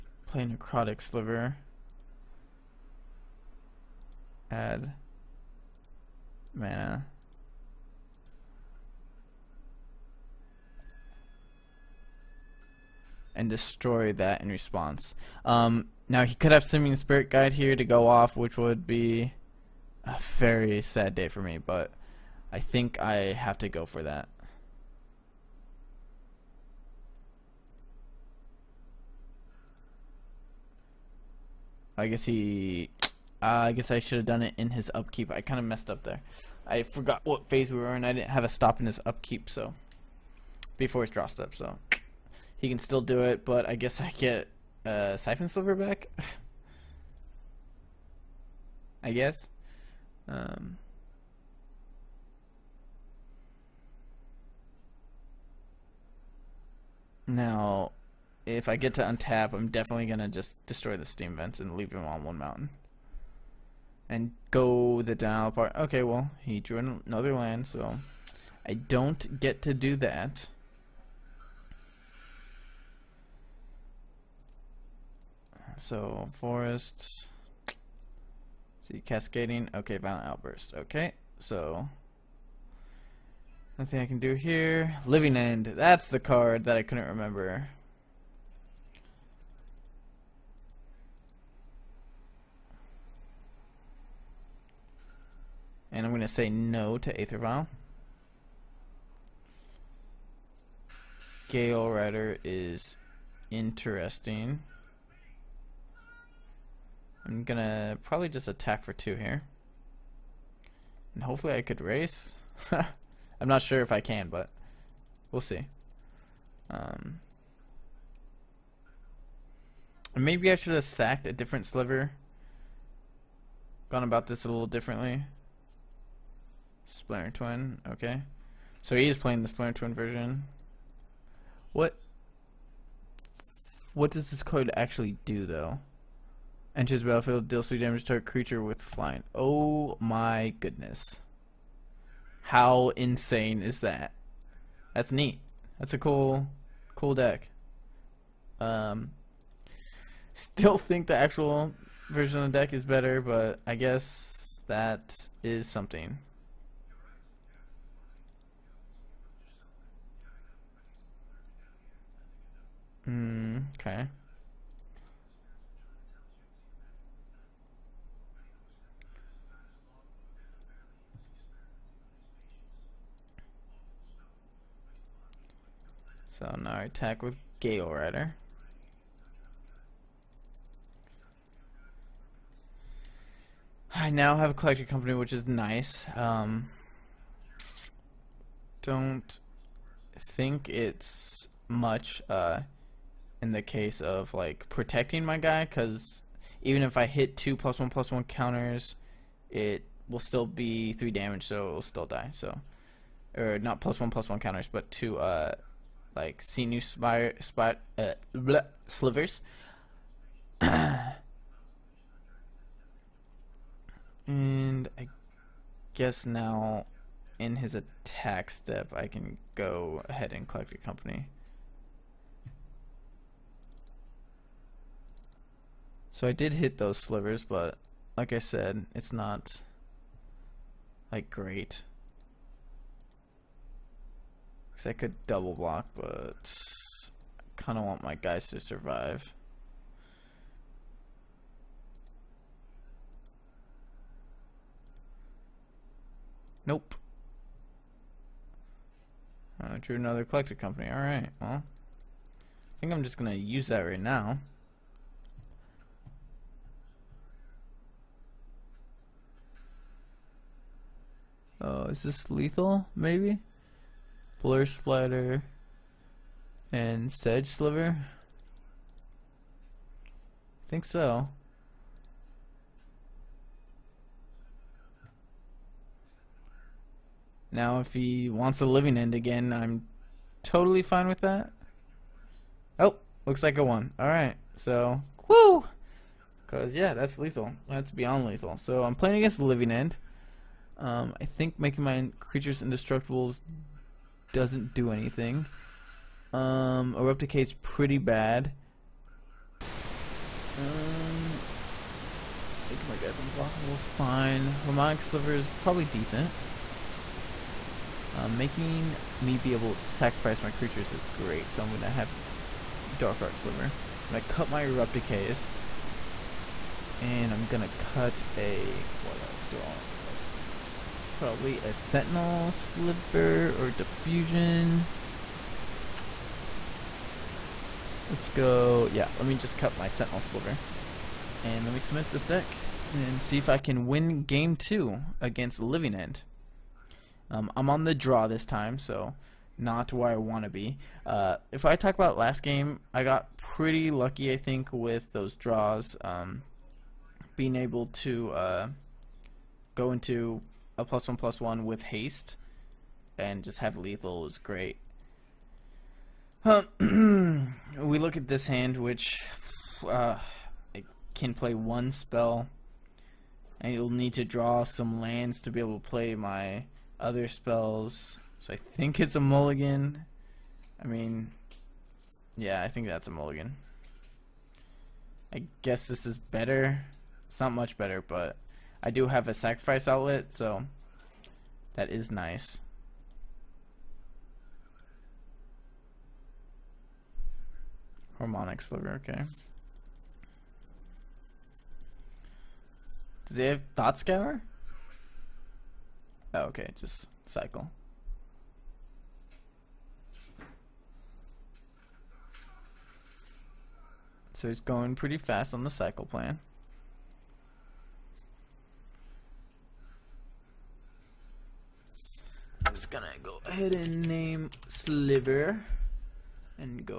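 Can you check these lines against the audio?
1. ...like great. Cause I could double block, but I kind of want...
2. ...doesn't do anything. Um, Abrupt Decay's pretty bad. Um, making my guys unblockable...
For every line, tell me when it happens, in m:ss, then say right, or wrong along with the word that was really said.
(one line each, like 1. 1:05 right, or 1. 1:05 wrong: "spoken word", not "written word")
1. 3:51 right
2. 4:54 right.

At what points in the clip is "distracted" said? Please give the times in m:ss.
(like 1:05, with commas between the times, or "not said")
not said.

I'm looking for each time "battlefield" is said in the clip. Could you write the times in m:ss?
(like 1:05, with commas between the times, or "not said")
2:17.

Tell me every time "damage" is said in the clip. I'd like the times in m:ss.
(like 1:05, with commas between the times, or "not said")
2:17, 3:21.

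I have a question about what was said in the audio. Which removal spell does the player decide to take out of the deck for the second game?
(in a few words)
Abrupt Decay.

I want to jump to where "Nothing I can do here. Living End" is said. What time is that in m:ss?
1:23.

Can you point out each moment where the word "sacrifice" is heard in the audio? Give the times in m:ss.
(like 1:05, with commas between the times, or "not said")
5:09, 6:19.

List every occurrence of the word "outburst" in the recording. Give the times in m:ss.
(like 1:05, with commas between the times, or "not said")
1:20.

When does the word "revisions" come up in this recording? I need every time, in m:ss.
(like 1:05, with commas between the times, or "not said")
not said.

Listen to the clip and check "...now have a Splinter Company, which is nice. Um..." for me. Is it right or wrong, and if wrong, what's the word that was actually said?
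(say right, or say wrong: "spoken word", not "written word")
wrong: "Collected", not "Splinter".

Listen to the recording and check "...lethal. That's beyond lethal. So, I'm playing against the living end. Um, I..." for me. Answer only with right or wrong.
right.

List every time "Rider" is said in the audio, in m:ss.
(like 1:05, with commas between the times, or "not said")
1:41, 2:57.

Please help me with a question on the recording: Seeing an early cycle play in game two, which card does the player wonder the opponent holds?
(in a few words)
Thought Scanner.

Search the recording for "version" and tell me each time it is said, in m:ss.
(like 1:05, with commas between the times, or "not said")
2:09, 2:32.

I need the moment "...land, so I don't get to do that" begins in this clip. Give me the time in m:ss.
1:07.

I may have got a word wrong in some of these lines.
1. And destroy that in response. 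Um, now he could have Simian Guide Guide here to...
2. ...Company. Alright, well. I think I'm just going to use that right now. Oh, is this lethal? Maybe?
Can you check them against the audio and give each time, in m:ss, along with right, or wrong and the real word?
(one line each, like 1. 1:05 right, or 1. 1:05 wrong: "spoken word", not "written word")
1. 0:13 wrong: "Spirit", not "Guide"
2. 4:10 right.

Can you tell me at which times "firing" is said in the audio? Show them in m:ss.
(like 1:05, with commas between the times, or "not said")
not said.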